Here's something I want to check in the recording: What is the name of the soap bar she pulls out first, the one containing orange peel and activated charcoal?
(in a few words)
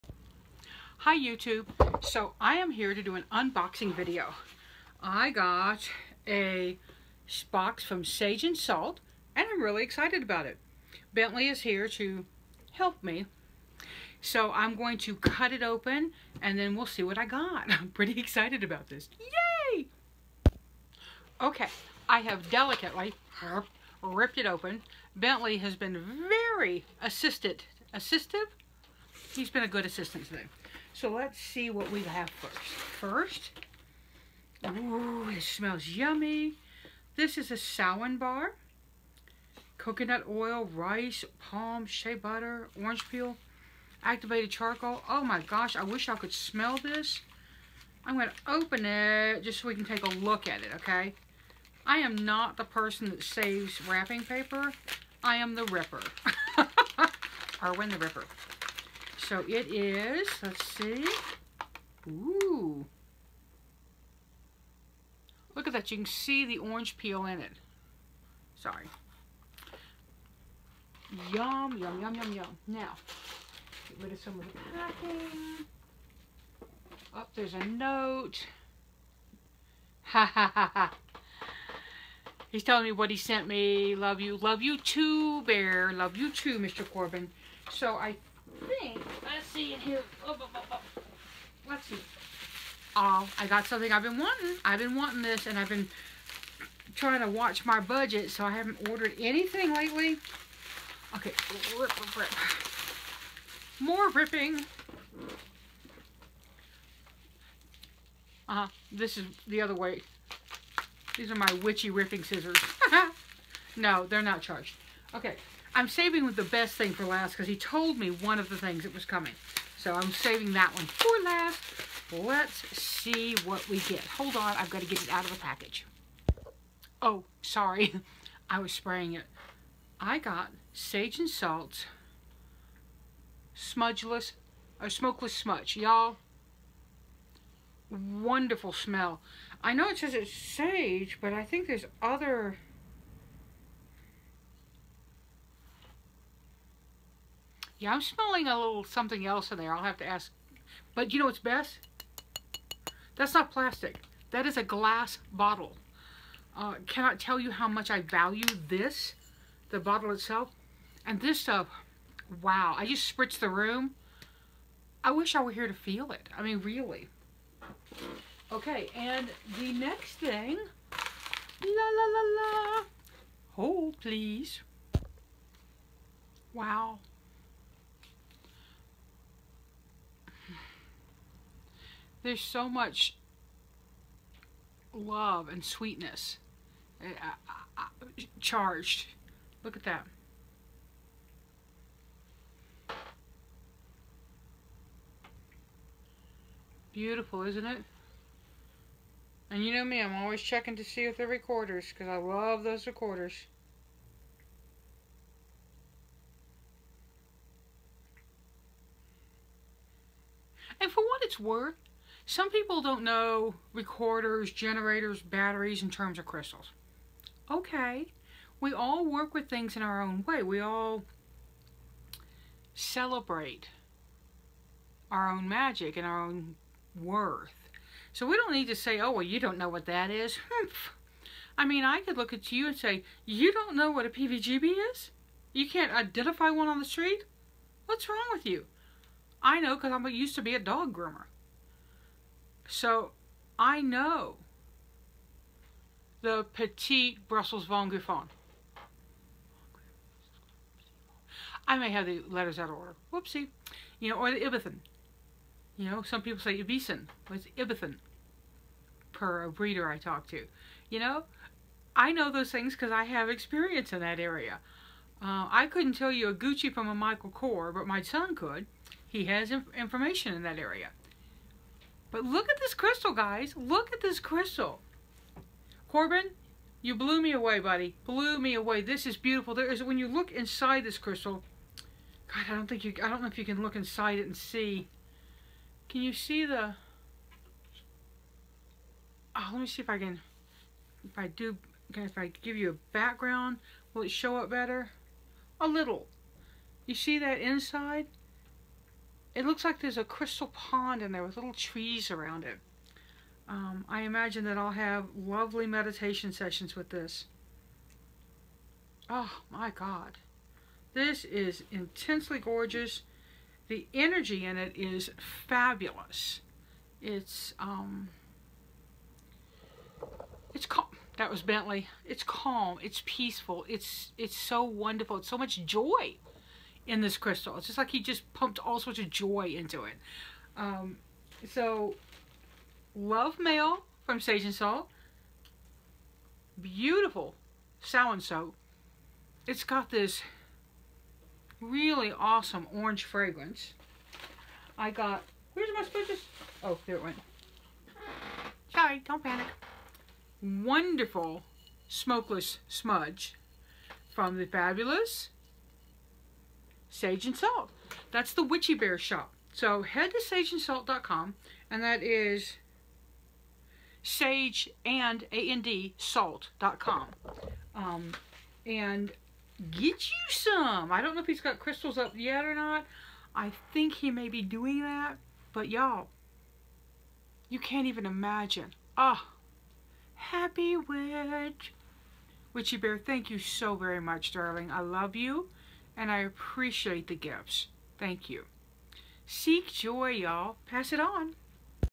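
Samhain bar.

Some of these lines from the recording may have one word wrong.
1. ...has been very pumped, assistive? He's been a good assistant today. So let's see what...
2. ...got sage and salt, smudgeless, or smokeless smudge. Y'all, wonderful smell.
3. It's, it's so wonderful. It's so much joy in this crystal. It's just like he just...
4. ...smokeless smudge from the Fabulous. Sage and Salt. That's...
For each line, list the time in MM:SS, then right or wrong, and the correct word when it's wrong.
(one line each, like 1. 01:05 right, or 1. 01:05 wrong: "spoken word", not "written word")
1. 00:25 wrong: "assisted", not "pumped"
2. 02:10 right
3. 05:23 right
4. 05:51 right.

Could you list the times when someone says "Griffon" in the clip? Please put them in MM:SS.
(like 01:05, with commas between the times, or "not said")
04:07.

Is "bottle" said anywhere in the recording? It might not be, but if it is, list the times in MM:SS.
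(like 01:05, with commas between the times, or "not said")
02:35, 02:39.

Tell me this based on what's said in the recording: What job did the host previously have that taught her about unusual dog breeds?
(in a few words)
Dog groomer.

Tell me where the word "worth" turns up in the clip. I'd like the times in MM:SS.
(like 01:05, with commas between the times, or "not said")
03:31, 03:46.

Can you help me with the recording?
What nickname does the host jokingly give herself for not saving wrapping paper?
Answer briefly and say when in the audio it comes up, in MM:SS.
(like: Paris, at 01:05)
Arwen the Ripper, at 00:57.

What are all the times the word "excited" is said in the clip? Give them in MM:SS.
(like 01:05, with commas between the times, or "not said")
00:09, 00:18.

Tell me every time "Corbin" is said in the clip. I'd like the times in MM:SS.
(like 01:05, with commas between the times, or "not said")
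01:26, 04:35.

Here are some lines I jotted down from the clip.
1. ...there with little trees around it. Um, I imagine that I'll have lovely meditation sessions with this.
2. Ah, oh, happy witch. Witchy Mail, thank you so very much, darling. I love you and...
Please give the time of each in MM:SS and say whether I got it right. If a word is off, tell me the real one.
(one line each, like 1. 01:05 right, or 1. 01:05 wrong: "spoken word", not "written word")
1. 05:01 right
2. 06:18 wrong: "Bear", not "Mail".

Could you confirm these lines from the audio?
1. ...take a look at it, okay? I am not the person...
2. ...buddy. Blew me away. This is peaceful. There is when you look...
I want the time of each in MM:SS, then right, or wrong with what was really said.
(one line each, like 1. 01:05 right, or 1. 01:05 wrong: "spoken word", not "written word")
1. 00:49 right
2. 04:37 wrong: "beautiful", not "peaceful".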